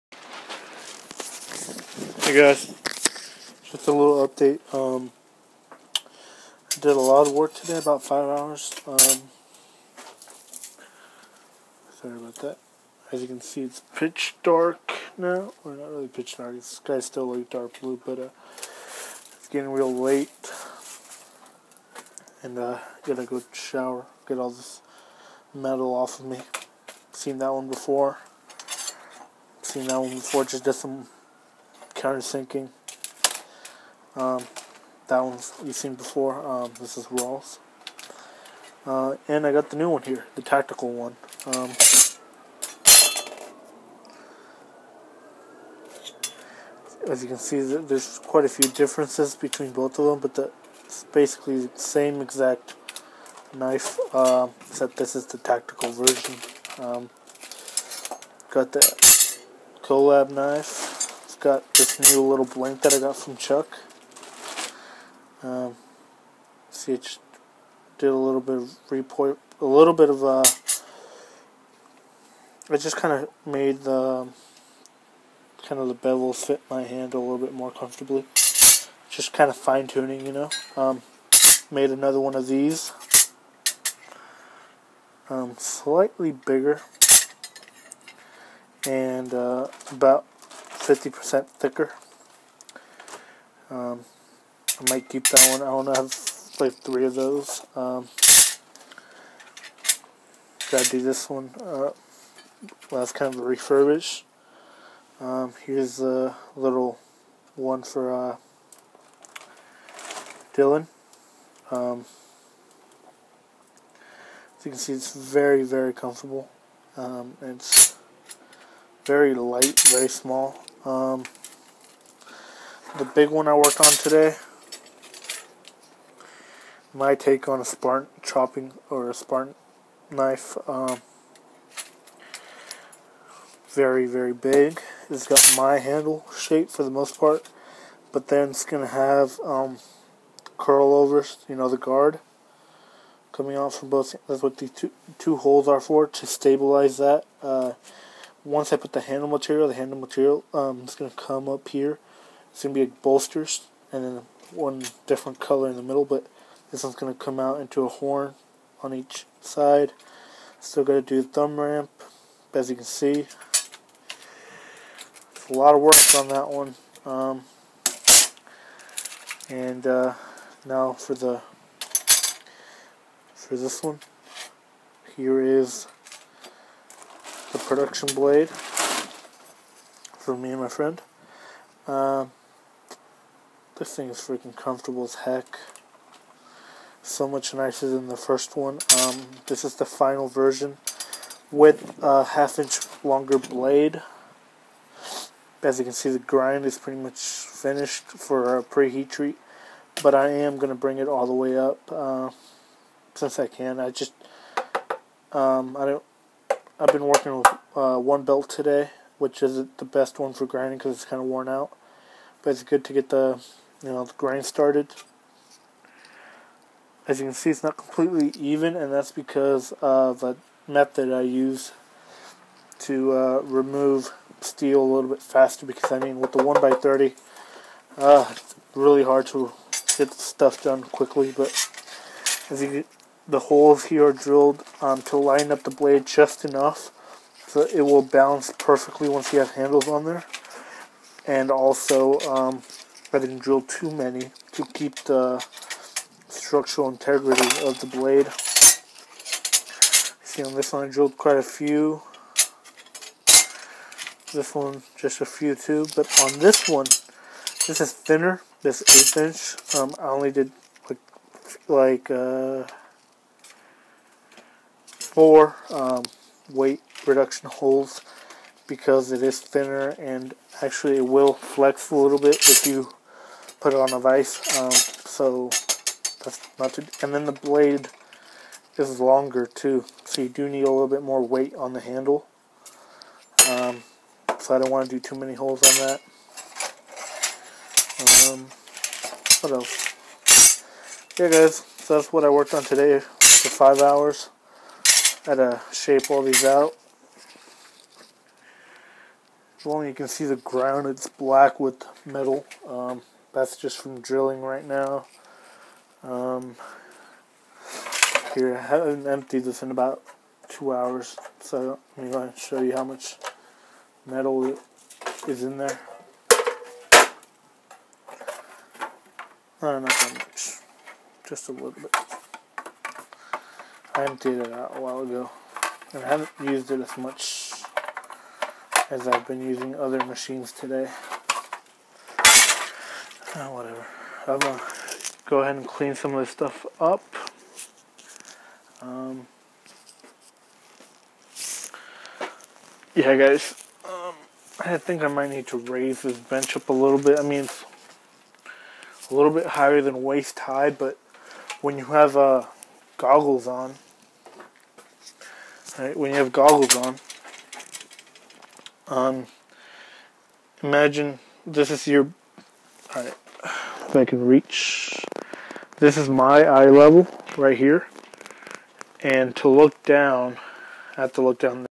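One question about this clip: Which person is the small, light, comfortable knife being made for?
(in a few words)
Dylan.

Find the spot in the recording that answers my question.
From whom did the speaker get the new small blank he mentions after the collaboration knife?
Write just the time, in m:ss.
1:03.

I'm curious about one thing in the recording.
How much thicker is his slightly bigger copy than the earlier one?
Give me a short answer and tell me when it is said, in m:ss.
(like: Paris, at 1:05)
50%, at 1:30.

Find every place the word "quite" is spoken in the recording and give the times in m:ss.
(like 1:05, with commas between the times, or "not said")
0:48, 4:11.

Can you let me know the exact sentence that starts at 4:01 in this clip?
And also, um, I didn't drill too many to keep the structural integrity of the blade.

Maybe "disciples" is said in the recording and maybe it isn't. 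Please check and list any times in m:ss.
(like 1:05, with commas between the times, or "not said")
not said.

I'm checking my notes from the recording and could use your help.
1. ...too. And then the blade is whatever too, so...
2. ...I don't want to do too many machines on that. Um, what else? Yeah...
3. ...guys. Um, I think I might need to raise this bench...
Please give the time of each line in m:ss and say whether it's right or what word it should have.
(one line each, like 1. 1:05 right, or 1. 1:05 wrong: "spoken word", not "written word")
1. 4:36 wrong: "longer", not "whatever"
2. 4:44 wrong: "holes", not "machines"
3. 5:43 right.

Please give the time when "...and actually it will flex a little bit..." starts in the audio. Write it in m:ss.
4:29.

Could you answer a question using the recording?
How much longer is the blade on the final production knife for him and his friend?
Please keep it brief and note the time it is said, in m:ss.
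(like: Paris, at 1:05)
half inch, at 3:12.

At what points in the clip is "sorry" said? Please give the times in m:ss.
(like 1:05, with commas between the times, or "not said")
0:12.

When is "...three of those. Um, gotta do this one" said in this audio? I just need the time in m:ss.
1:36.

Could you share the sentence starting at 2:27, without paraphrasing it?
Uh, once I put the handle material, the handle material um, is going to come up here.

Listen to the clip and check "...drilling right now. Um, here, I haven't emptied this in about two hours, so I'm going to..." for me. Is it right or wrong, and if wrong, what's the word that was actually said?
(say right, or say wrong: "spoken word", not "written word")
right.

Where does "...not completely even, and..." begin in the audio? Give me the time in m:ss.
3:37.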